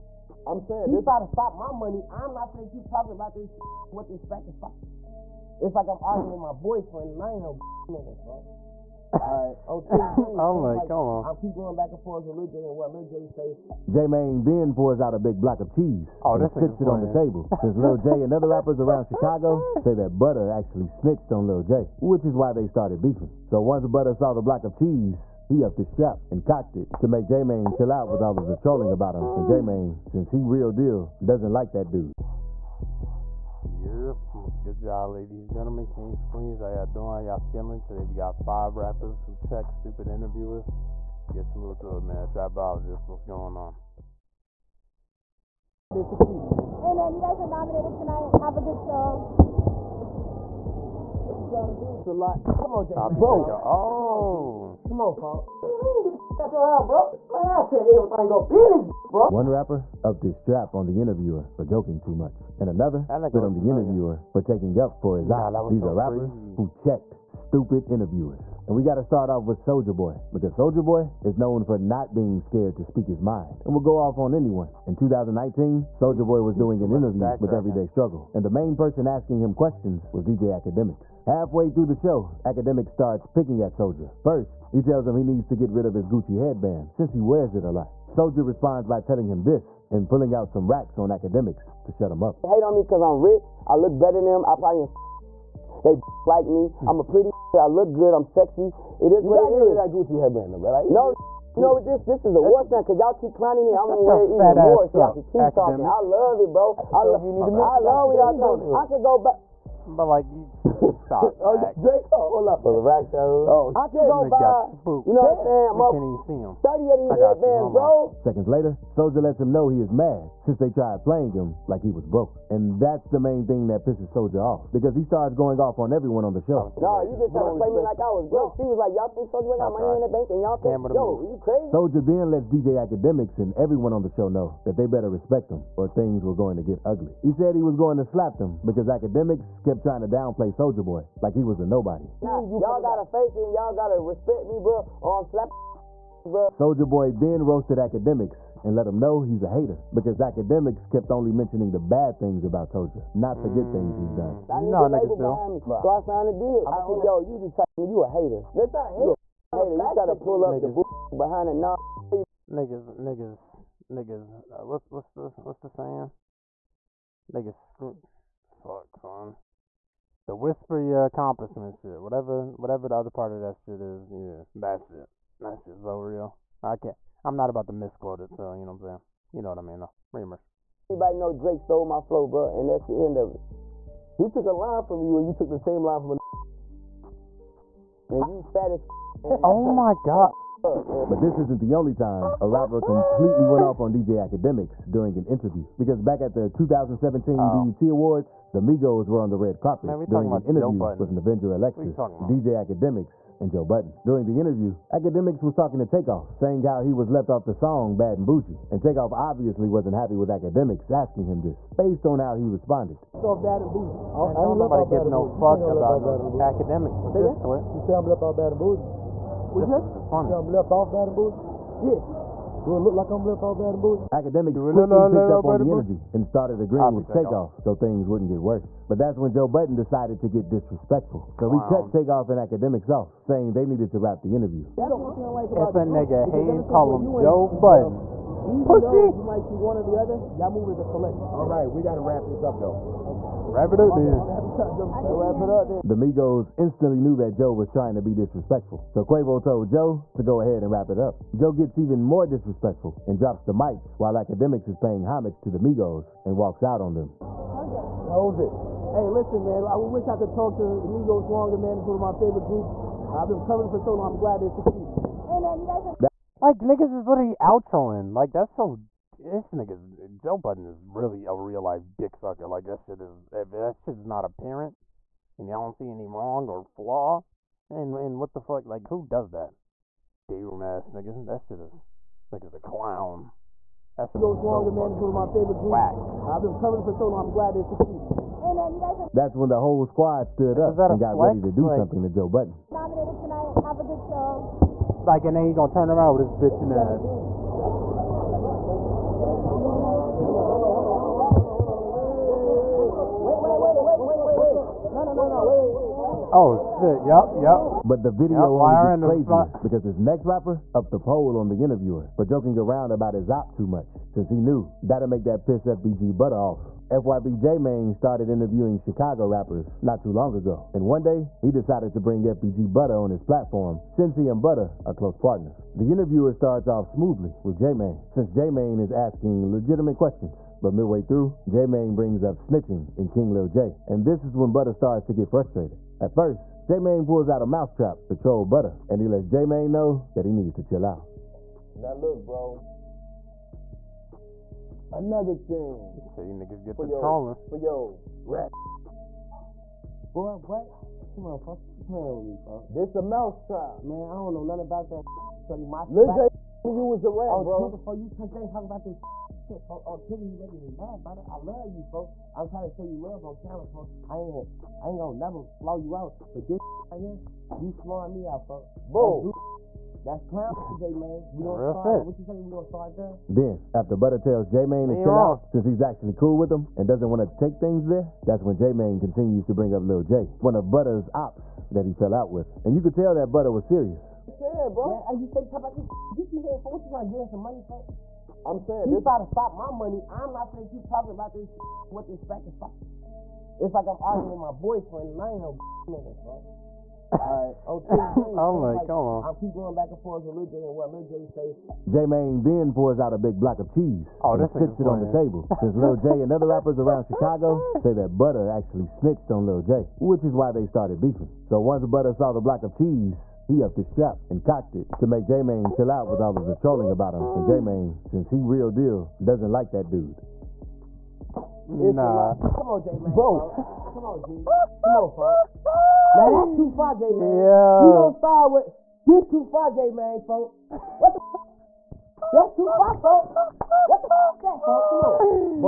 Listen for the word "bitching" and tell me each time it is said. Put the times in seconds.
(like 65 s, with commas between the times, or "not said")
296 s.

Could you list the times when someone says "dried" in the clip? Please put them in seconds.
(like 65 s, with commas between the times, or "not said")
not said.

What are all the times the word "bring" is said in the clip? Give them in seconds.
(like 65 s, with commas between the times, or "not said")
322 s, 331 s, 379 s.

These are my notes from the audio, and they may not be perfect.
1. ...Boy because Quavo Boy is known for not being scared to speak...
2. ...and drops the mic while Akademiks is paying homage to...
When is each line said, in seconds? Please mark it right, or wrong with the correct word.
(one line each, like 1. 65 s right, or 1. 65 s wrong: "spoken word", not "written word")
1. 69 s wrong: "Soulja", not "Quavo"
2. 253 s right.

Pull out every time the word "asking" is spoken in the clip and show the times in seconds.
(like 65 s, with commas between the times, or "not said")
79 s, 210 s, 328 s.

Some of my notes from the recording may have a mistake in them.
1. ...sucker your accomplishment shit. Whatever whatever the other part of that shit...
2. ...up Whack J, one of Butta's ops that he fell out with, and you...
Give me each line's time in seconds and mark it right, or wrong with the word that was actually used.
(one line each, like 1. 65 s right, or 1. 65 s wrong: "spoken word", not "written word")
1. 170 s wrong: "whisper", not "sucker"
2. 379 s wrong: "Lil", not "Whack".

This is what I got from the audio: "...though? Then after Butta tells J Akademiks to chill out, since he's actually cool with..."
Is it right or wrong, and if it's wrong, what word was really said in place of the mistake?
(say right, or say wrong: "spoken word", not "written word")
wrong: "Mane", not "Akademiks".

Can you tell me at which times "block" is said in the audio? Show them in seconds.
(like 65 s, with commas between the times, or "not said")
15 s, 24 s, 403 s, 412 s.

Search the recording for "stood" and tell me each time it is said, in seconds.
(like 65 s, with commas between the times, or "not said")
290 s.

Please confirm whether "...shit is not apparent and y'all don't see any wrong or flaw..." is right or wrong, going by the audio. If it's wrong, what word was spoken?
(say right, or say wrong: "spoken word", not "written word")
right.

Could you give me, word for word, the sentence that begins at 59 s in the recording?
One rapper upped his strap on the interviewer for joking too much, and another like spit on the familiar.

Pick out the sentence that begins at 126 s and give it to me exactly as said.
No, you just trying to play me like I was broke.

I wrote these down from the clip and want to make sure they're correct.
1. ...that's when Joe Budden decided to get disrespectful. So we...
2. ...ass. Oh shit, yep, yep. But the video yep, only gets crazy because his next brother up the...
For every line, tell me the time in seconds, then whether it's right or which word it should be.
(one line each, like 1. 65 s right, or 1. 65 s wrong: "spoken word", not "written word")
1. 228 s right
2. 296 s wrong: "rapper", not "brother".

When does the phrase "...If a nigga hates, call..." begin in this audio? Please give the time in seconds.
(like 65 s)
235 s.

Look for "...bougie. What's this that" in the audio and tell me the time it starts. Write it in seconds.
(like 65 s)
218 s.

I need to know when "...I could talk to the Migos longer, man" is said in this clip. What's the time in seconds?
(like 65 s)
260 s.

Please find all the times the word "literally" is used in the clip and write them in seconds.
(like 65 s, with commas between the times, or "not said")
267 s.